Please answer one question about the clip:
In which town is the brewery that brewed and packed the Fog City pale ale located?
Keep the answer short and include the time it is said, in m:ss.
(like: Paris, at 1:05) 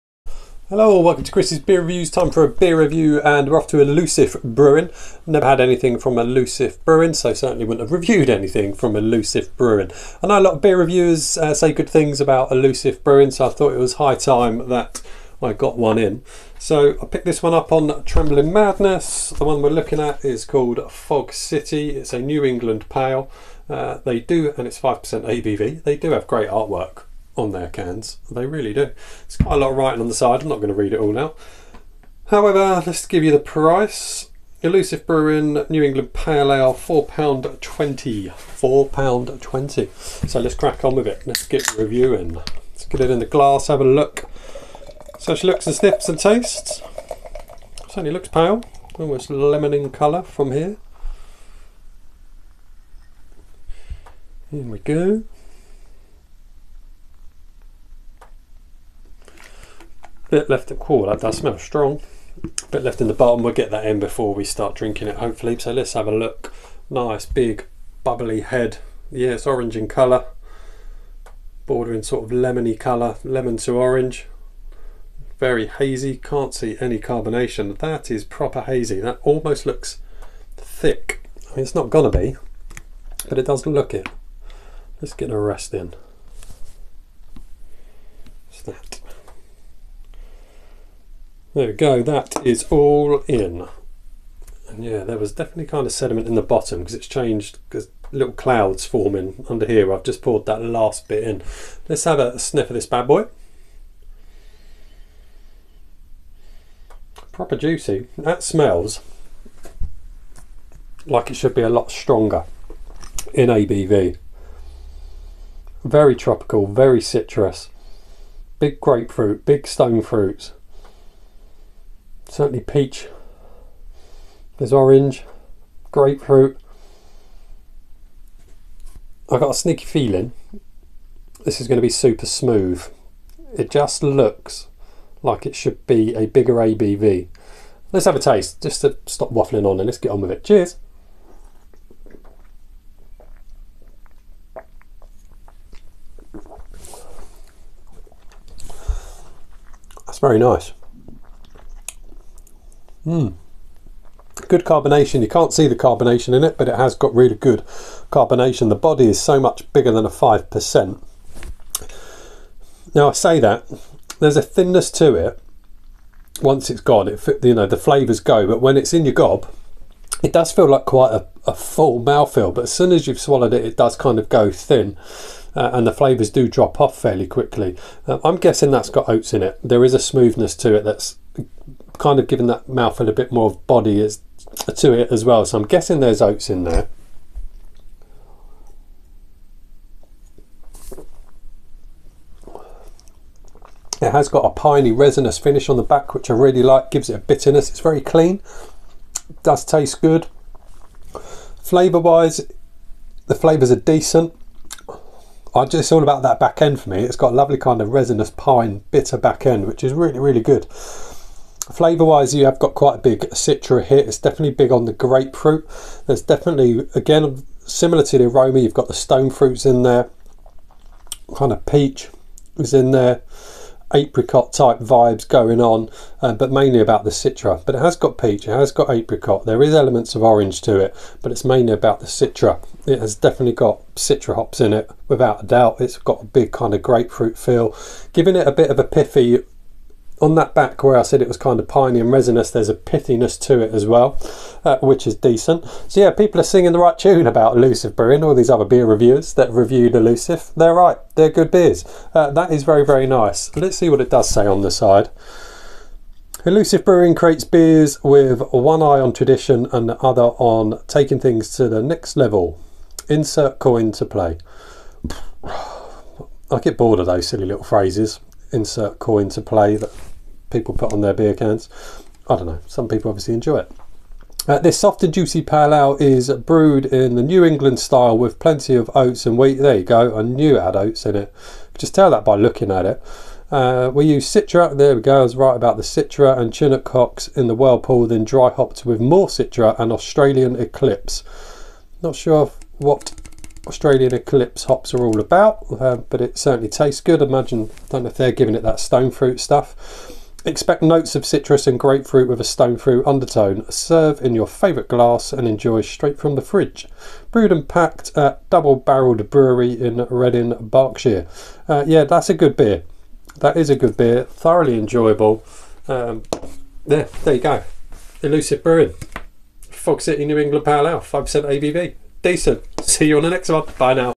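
Reading, at 5:10.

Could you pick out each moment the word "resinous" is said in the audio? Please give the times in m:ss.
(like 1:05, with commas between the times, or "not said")
3:14, 3:27, 4:02.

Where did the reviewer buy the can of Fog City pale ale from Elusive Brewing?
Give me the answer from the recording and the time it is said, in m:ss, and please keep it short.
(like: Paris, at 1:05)
Trembling Madness, at 0:18.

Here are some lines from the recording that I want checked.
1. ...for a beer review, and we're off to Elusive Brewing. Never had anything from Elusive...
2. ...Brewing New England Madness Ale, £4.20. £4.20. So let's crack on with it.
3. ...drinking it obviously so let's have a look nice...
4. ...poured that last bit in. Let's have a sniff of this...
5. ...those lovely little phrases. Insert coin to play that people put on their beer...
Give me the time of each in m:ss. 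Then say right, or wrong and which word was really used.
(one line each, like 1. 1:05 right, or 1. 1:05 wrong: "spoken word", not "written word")
1. 0:02 right
2. 0:35 wrong: "Pale", not "Madness"
3. 1:04 wrong: "hopefully", not "obviously"
4. 1:40 right
5. 4:27 wrong: "silly", not "lovely".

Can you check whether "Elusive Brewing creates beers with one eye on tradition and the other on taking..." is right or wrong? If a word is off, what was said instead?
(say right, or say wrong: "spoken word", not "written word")
right.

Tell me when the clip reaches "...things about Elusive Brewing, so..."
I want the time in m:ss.
0:11.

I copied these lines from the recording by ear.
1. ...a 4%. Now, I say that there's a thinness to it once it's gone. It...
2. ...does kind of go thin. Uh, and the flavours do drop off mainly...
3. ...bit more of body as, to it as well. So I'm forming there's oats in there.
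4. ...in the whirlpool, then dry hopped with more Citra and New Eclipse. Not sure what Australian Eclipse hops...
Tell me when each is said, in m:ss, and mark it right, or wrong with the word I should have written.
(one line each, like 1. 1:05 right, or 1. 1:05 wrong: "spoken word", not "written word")
1. 2:40 wrong: "5", not "4"
2. 2:53 wrong: "fairly", not "mainly"
3. 3:03 wrong: "guessing", not "forming"
4. 4:47 wrong: "Australian", not "New".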